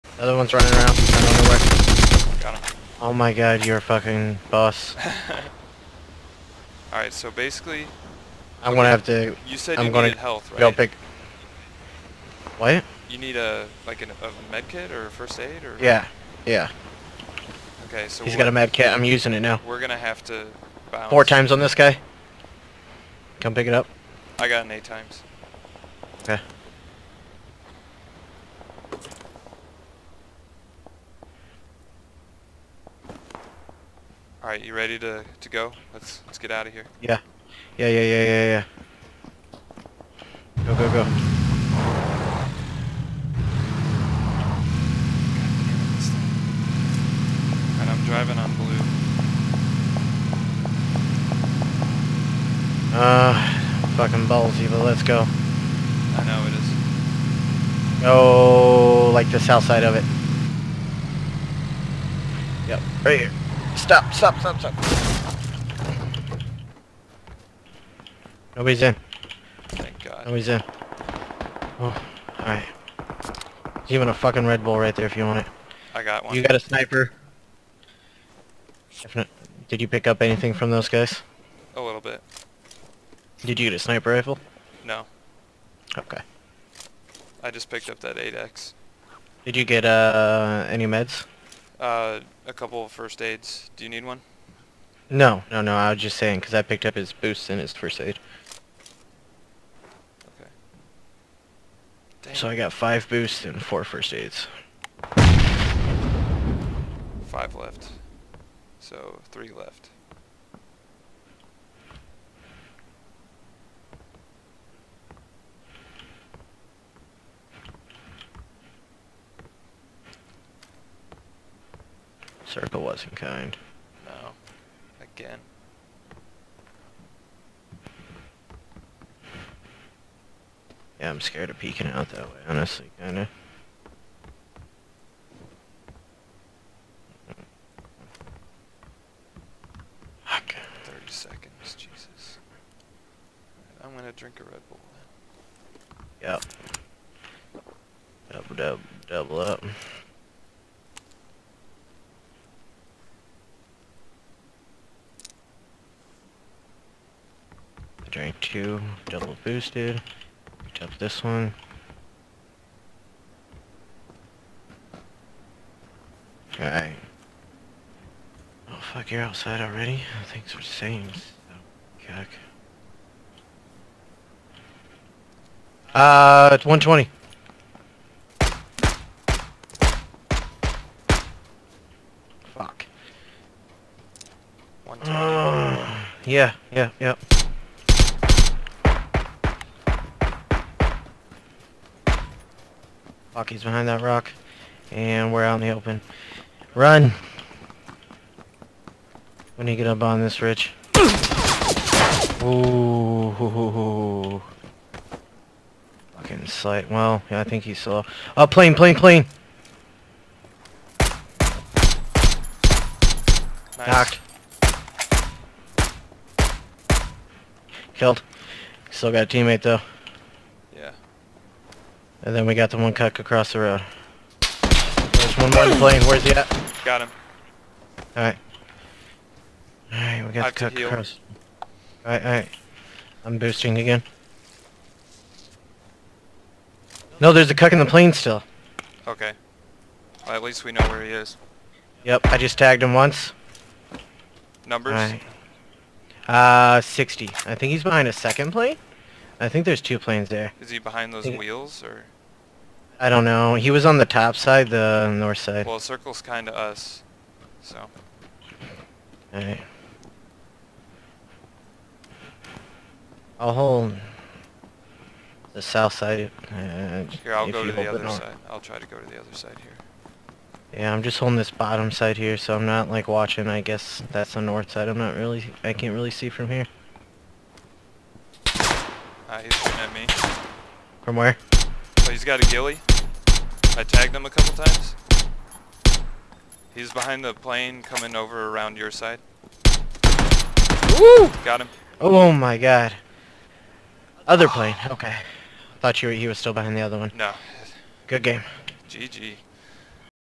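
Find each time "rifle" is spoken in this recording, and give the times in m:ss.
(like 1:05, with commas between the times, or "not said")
1:24.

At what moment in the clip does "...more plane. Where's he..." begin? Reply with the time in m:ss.
3:45.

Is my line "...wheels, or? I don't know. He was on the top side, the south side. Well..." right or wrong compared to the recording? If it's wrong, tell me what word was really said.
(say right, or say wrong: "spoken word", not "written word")
wrong: "north", not "south".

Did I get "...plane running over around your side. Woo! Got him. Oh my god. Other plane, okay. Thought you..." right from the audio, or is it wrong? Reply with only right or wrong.
wrong.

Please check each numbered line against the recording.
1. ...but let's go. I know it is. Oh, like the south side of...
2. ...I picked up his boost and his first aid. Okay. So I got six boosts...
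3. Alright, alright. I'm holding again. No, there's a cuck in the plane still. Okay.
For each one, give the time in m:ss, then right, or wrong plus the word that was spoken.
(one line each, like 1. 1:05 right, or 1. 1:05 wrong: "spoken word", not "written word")
1. 0:54 right
2. 1:36 wrong: "five", not "six"
3. 3:52 wrong: "boosting", not "holding".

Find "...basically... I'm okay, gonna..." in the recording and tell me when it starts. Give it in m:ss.
0:07.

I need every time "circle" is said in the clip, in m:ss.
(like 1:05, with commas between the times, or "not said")
2:02, 4:15.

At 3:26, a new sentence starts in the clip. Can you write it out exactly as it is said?
Well, yeah, I think he saw.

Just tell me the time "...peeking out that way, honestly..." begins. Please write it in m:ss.
2:11.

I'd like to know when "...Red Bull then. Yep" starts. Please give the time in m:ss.
2:24.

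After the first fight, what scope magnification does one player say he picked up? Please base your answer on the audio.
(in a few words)
8x.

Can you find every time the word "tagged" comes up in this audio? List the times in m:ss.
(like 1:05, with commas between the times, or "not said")
4:02, 4:43.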